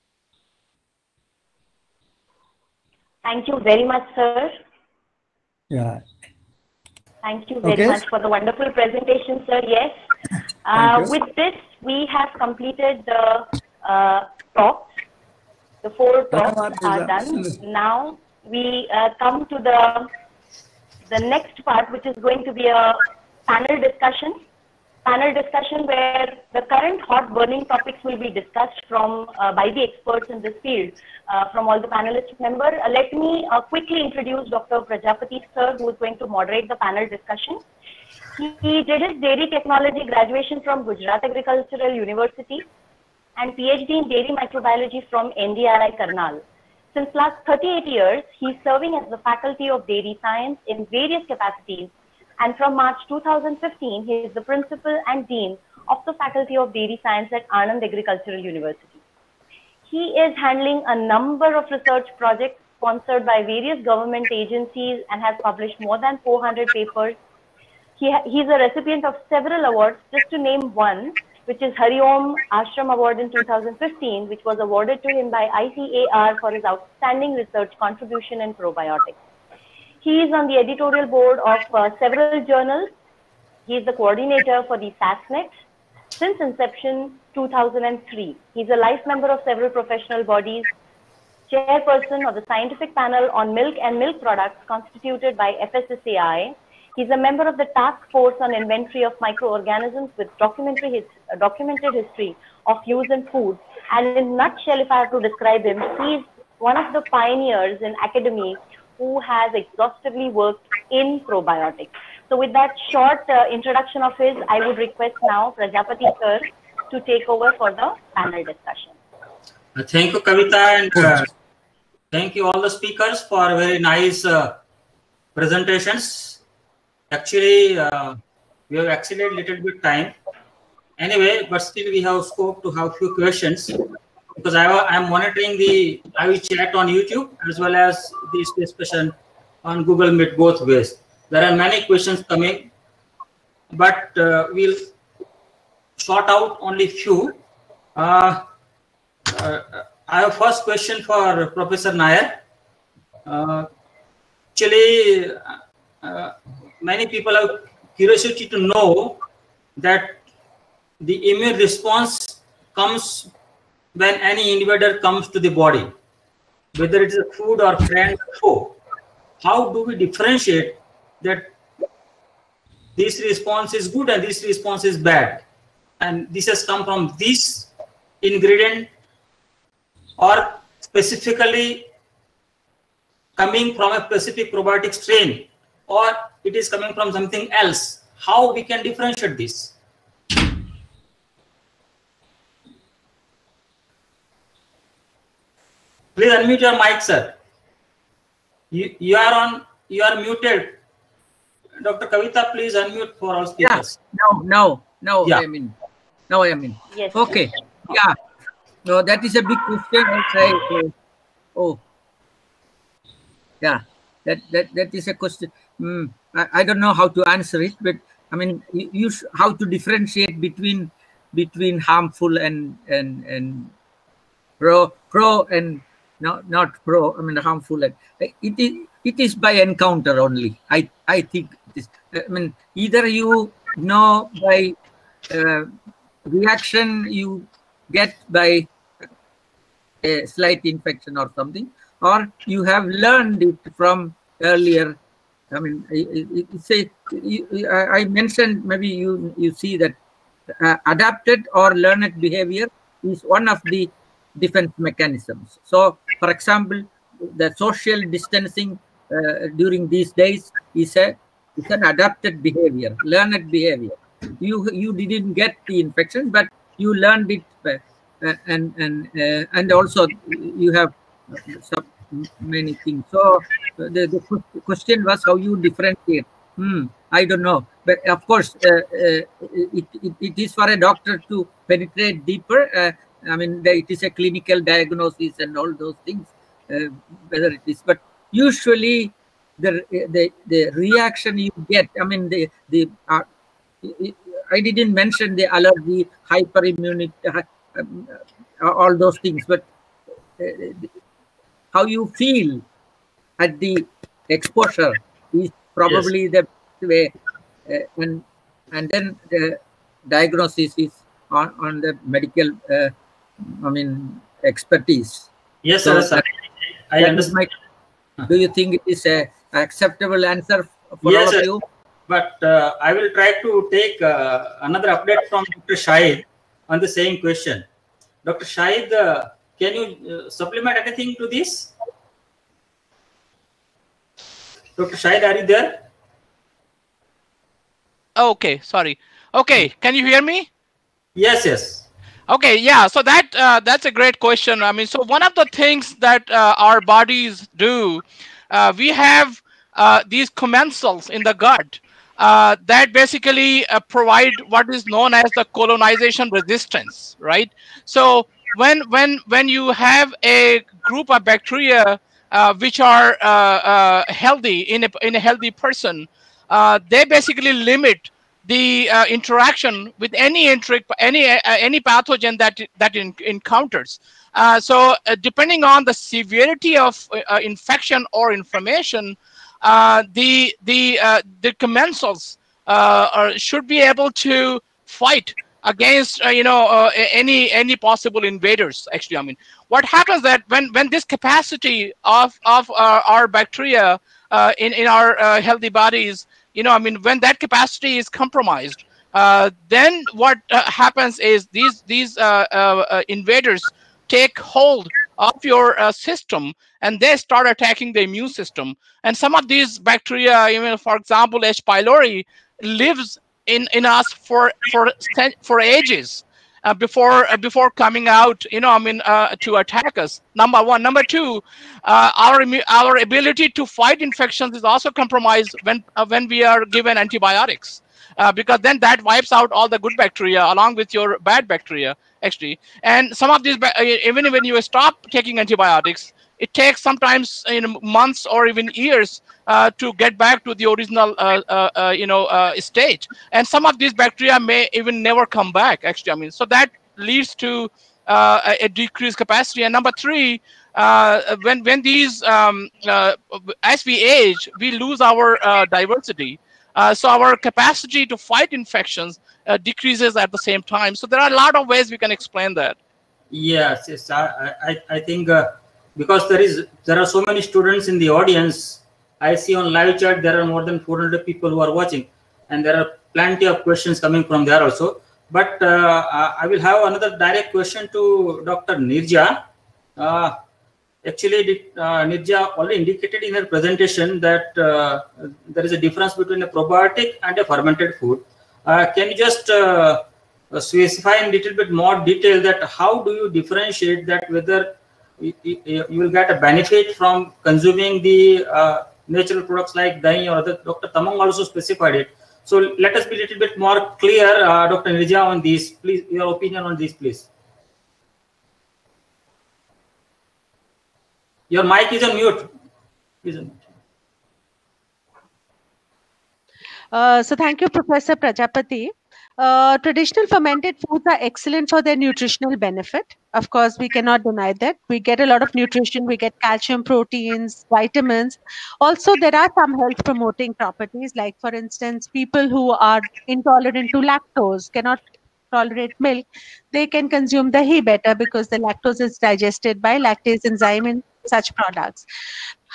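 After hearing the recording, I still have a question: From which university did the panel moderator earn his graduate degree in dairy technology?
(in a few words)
Gujarat Agricultural University.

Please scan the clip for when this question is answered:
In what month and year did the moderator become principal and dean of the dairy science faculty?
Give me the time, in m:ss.
0:52.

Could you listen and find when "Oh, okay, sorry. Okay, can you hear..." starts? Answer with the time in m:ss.
5:38.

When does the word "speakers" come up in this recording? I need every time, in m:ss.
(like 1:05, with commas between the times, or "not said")
2:02, 3:23.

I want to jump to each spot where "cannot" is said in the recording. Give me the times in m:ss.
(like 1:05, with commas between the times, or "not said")
8:43, 8:54.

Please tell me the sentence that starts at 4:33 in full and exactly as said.
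So the, the question was how you differentiate.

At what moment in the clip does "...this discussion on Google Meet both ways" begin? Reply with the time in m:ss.
2:18.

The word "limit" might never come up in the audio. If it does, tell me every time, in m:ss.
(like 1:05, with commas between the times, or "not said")
6:07.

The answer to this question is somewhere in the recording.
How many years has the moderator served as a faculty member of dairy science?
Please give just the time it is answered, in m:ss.
0:47.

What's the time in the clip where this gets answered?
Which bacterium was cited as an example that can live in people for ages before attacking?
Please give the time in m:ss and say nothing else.
6:51.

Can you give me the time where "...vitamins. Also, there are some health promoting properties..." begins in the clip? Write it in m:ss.
8:47.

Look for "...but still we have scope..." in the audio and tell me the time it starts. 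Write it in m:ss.
2:11.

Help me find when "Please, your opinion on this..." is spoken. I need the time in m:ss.
8:25.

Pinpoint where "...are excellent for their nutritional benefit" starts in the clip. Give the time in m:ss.
8:41.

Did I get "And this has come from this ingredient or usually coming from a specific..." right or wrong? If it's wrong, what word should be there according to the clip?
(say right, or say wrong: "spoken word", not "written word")
wrong: "specifically", not "usually".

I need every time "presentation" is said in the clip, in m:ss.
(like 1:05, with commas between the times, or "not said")
0:08, 2:05, 8:03.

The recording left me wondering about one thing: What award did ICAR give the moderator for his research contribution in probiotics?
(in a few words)
Hari Om Ashram Award.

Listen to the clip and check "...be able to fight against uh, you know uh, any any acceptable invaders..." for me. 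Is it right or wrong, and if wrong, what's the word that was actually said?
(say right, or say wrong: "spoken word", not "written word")
wrong: "possible", not "acceptable".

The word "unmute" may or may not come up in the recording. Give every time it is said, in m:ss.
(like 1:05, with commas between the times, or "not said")
3:16, 3:22.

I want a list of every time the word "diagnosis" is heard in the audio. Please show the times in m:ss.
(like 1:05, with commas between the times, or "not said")
4:44, 5:10.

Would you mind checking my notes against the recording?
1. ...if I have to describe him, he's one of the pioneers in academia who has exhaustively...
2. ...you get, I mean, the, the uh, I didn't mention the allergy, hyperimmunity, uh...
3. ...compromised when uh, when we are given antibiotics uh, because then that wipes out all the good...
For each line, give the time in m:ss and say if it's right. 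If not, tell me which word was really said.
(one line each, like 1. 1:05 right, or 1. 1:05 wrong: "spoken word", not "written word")
1. 1:44 right
2. 4:51 right
3. 7:04 right.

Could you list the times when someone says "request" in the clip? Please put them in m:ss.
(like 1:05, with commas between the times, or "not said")
1:54.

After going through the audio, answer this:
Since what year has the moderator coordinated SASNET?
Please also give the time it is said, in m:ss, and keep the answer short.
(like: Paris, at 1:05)
2003, at 1:27.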